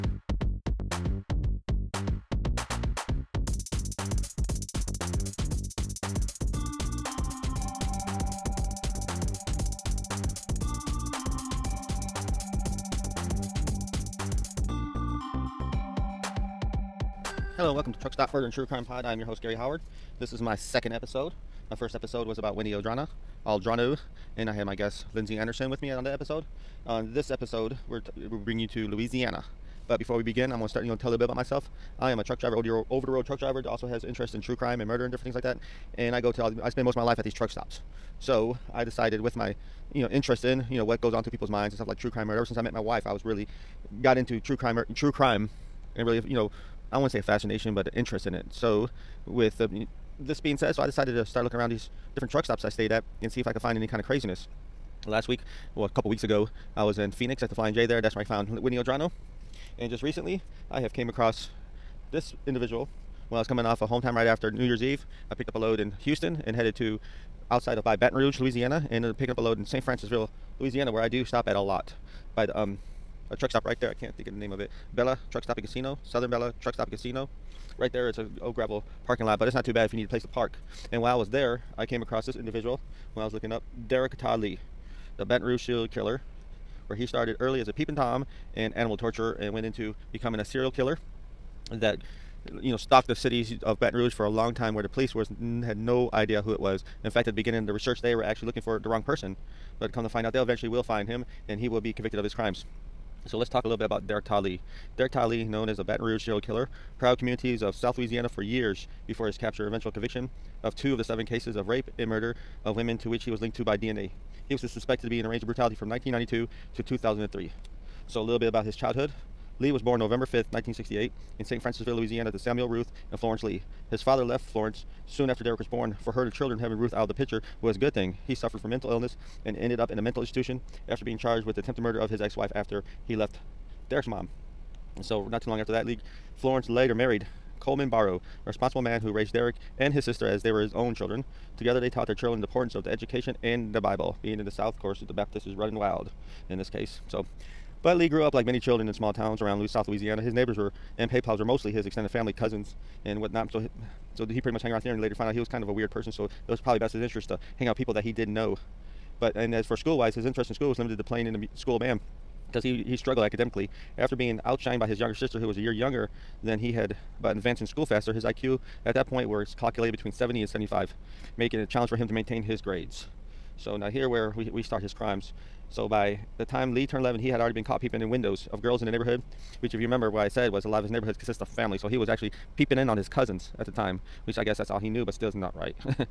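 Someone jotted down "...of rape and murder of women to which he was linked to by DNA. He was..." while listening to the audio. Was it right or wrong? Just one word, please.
right.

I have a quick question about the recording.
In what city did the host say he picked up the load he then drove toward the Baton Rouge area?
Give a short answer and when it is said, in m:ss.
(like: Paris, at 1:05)
Houston, at 1:05.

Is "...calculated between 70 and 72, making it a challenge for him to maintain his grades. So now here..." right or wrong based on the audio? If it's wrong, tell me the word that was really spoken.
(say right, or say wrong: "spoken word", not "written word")
wrong: "75", not "72".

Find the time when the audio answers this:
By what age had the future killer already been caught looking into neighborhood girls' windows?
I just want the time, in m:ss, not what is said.
2:57.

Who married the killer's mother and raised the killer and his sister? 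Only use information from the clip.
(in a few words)
Coleman Barrow.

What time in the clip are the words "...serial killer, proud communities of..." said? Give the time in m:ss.
1:46.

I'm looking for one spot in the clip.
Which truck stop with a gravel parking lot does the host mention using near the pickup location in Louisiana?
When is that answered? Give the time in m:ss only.
1:16.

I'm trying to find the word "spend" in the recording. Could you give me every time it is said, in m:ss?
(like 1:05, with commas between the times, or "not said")
0:36.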